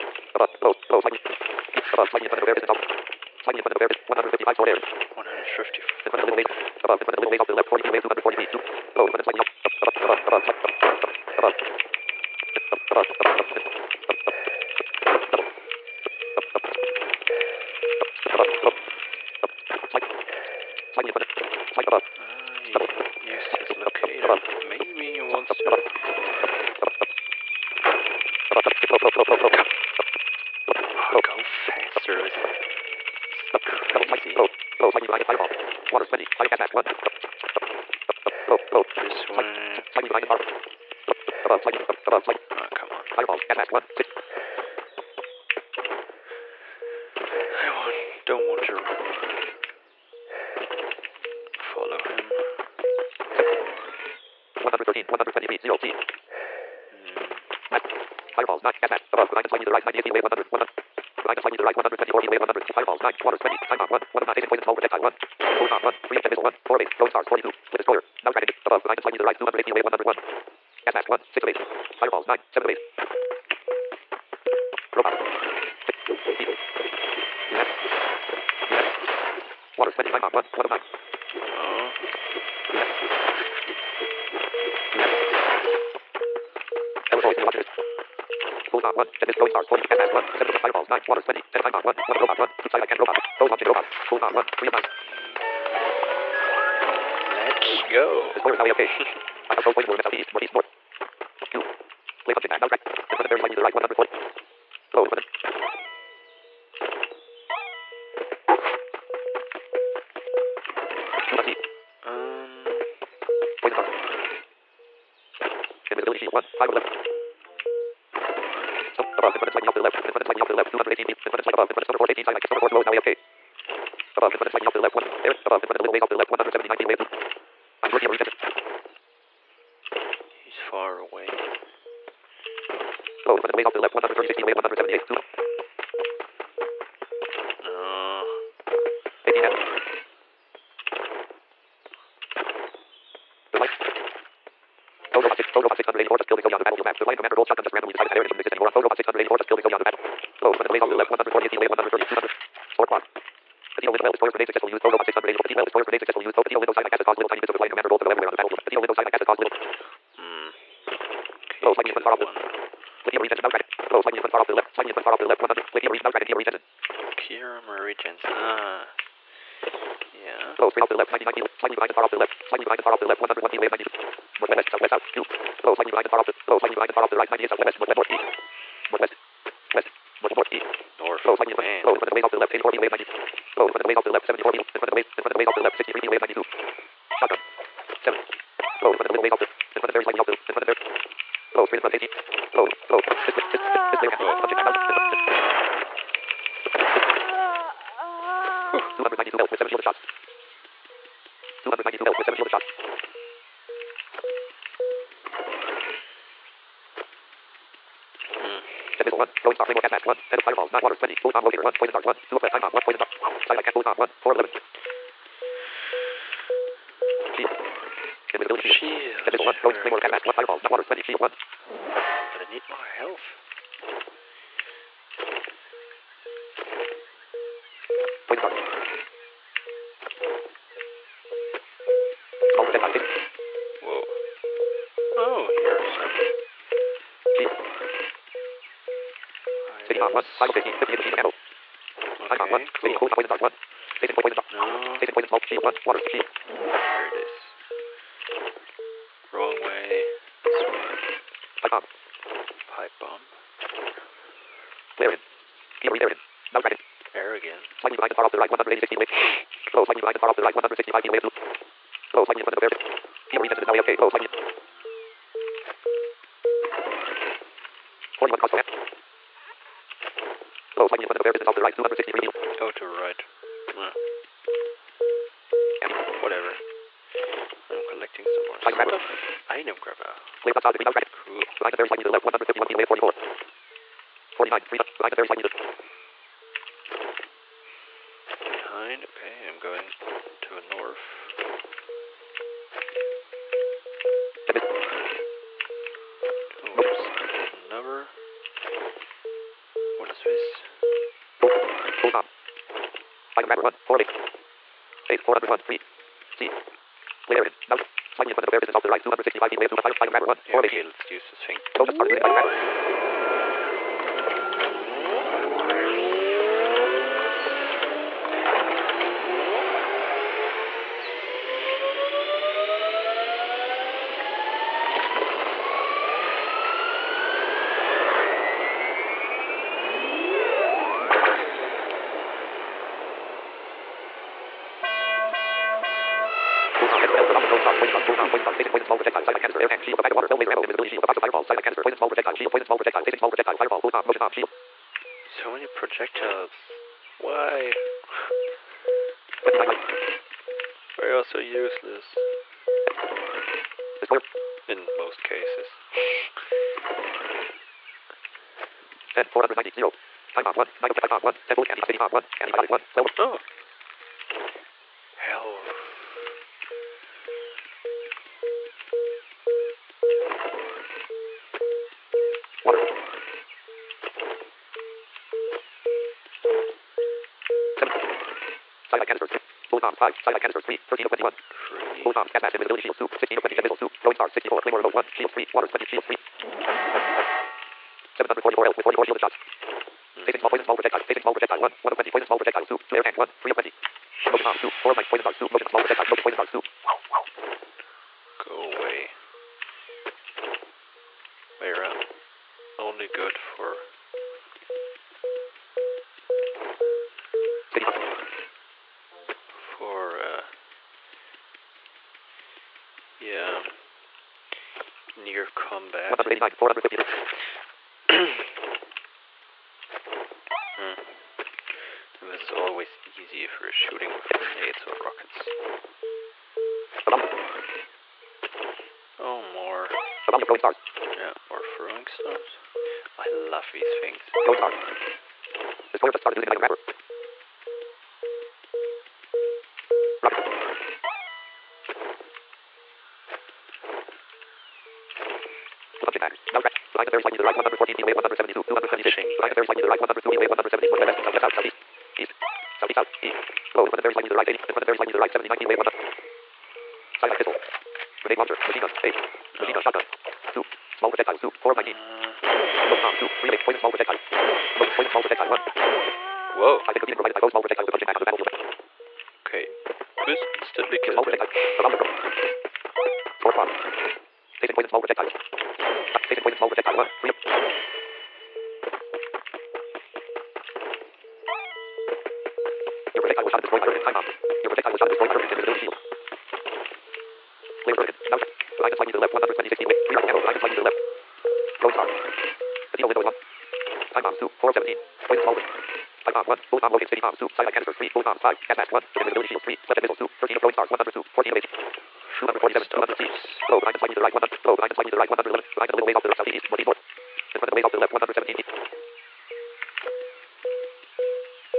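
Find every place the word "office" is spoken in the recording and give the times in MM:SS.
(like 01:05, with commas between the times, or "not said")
not said.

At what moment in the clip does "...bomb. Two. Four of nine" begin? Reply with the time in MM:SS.
06:34.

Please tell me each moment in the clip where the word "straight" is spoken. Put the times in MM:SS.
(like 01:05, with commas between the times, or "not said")
02:50, 03:11.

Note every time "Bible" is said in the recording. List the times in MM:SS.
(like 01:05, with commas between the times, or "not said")
04:00.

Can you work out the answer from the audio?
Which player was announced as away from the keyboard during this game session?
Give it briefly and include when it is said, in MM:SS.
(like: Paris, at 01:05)
Keyboard resistance, at 04:23.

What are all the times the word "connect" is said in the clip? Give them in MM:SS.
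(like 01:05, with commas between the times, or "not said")
not said.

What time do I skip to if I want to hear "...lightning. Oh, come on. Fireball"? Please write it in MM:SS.
00:42.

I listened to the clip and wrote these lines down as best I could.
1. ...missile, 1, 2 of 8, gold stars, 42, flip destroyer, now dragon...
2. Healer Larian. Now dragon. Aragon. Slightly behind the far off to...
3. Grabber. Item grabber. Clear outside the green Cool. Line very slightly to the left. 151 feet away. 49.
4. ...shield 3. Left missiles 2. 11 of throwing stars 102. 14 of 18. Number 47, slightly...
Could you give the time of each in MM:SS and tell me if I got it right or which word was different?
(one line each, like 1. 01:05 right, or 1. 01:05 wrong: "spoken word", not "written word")
1. 01:06 wrong: "4", not "2"
2. 04:15 right
3. 04:39 wrong: "44", not "49"
4. 08:19 wrong: "13", not "11".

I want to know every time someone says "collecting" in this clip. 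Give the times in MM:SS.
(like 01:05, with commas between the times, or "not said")
04:37.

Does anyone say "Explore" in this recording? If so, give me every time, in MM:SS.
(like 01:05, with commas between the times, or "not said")
01:38.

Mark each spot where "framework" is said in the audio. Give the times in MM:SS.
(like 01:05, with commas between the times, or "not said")
03:29, 03:39.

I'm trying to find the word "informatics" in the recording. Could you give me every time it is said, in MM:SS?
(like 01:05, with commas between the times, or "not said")
not said.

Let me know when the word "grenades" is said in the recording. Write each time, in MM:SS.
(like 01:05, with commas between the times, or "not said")
07:04, 07:38.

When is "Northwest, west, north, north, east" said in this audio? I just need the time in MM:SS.
02:58.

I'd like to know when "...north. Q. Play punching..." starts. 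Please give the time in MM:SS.
01:40.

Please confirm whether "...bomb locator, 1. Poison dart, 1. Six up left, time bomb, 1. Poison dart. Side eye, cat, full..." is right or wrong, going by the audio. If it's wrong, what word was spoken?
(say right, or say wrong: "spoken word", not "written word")
wrong: "Two", not "Six".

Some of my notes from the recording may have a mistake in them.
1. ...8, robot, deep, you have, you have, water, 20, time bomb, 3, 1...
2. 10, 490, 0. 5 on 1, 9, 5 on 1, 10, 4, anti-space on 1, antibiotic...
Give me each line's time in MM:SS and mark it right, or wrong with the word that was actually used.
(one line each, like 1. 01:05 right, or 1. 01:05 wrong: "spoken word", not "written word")
1. 01:12 wrong: "1", not "3"
2. 05:59 right.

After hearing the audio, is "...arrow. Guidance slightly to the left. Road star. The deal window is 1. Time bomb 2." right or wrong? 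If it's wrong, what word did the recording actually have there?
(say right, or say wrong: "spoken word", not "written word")
right.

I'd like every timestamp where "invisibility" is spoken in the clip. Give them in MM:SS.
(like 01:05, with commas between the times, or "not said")
01:55, 03:38, 08:05, 08:19.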